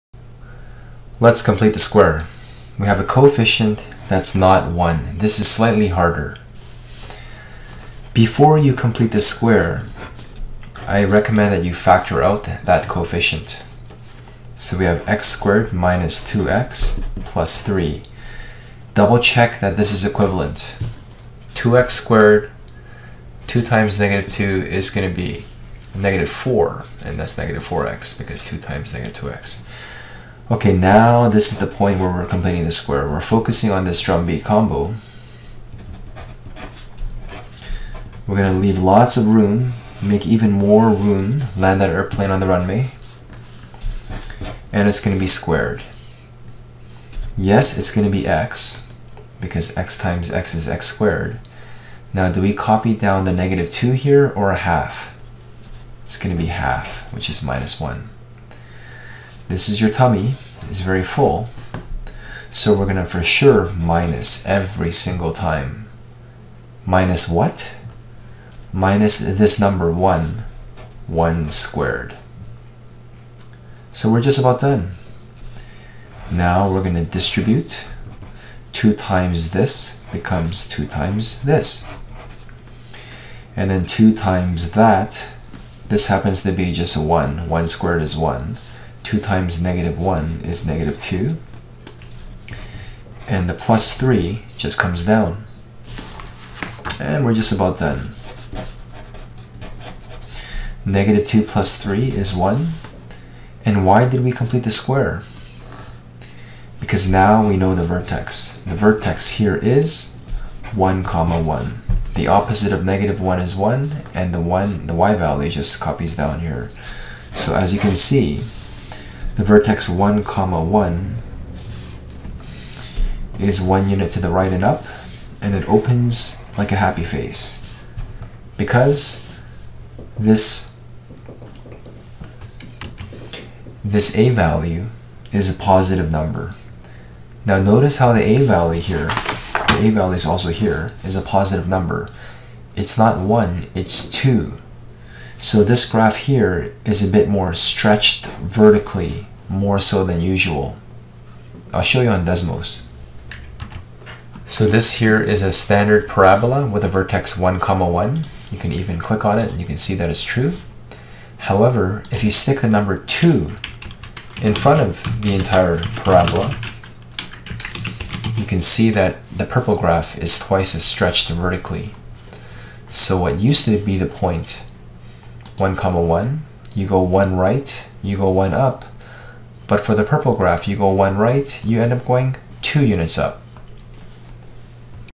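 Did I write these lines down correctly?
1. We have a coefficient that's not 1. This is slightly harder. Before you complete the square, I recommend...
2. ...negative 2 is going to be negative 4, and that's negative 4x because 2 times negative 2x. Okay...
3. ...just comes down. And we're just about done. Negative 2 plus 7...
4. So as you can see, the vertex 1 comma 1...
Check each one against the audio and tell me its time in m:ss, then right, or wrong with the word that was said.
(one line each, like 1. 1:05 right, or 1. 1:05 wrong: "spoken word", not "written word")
1. 0:02 right
2. 0:23 right
3. 1:34 wrong: "3", not "7"
4. 1:57 right.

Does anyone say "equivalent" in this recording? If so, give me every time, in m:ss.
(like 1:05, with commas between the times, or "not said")
0:20.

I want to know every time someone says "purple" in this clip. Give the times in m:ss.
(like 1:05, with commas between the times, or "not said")
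2:49, 3:00.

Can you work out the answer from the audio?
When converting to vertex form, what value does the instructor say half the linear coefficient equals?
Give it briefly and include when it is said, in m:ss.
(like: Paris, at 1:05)
-1, at 0:57.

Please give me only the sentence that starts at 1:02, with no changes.
So we're gonna for sure minus every single time.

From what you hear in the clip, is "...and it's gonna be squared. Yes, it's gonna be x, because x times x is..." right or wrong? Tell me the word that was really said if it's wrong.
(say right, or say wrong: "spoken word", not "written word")
right.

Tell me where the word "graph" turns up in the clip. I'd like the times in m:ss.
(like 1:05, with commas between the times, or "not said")
2:25, 2:49, 3:00.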